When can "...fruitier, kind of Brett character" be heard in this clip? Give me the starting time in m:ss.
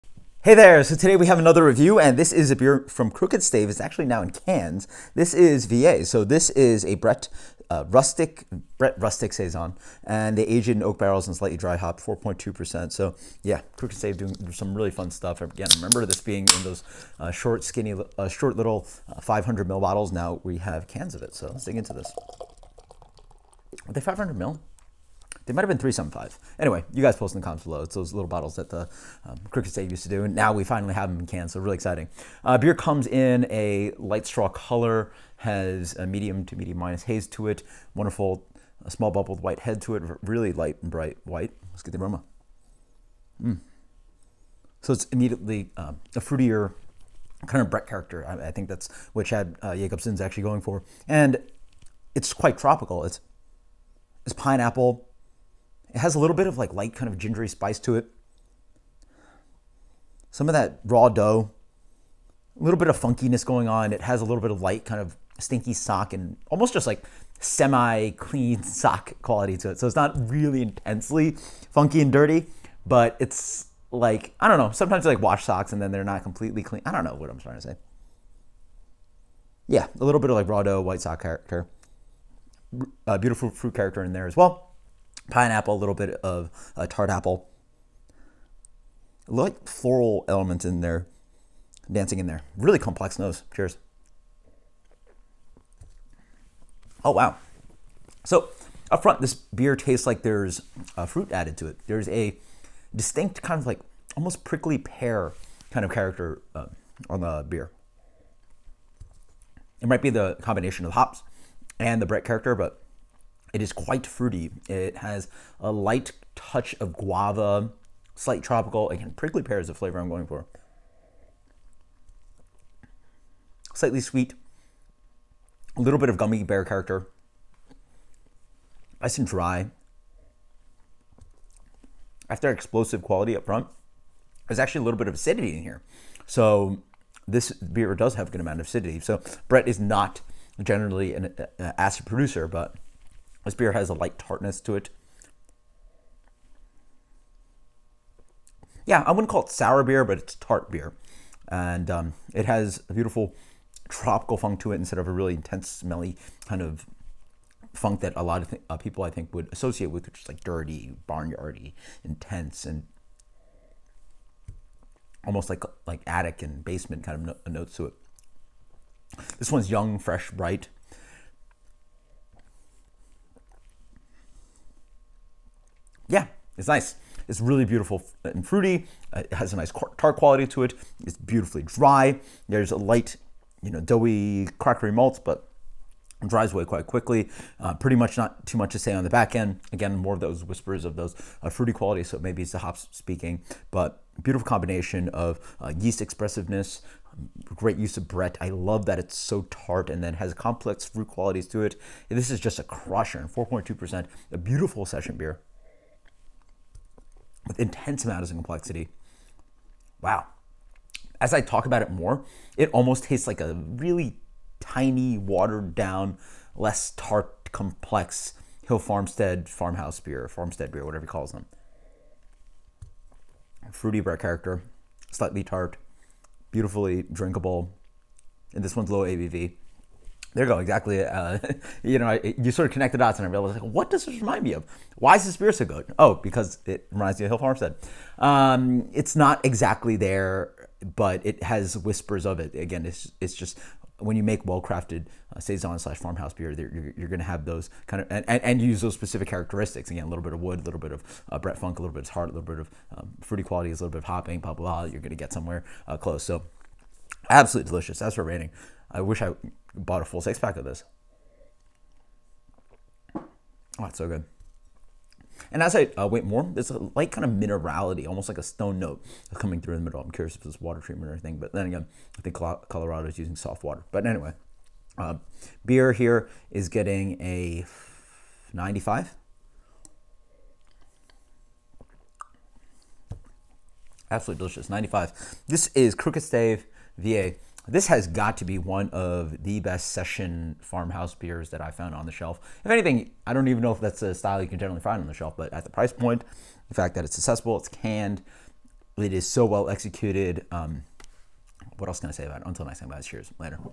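0:46.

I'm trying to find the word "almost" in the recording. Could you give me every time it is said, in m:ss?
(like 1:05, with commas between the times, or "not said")
1:06, 1:44, 2:45, 3:32, 4:28.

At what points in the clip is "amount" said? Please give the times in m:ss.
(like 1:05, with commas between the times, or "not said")
2:18, 3:28.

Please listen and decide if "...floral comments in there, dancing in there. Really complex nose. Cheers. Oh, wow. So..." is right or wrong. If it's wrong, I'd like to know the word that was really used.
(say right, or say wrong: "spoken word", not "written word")
wrong: "elements", not "comments".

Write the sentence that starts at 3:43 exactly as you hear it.
Fruity Brett character, slightly tart, beautifully drinkable, and this one's low ABV.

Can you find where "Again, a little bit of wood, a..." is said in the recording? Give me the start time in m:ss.
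4:09.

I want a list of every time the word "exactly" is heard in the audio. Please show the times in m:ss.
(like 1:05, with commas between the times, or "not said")
3:50, 3:59.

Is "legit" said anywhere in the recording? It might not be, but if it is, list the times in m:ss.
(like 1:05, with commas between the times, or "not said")
not said.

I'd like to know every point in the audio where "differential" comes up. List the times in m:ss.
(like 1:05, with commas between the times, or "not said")
not said.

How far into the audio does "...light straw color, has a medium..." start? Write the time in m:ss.
0:33.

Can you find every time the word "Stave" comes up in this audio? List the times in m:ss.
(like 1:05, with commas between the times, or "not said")
0:03, 0:13, 0:29, 4:46.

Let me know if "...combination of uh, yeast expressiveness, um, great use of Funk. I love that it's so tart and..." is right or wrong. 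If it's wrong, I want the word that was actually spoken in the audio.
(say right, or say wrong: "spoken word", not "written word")
wrong: "Brett", not "Funk".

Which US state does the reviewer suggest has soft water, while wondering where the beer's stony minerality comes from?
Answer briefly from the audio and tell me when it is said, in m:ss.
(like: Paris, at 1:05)
Colorado, at 4:32.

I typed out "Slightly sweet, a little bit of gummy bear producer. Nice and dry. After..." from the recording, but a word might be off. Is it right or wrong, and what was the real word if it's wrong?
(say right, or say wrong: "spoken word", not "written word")
wrong: "character", not "producer".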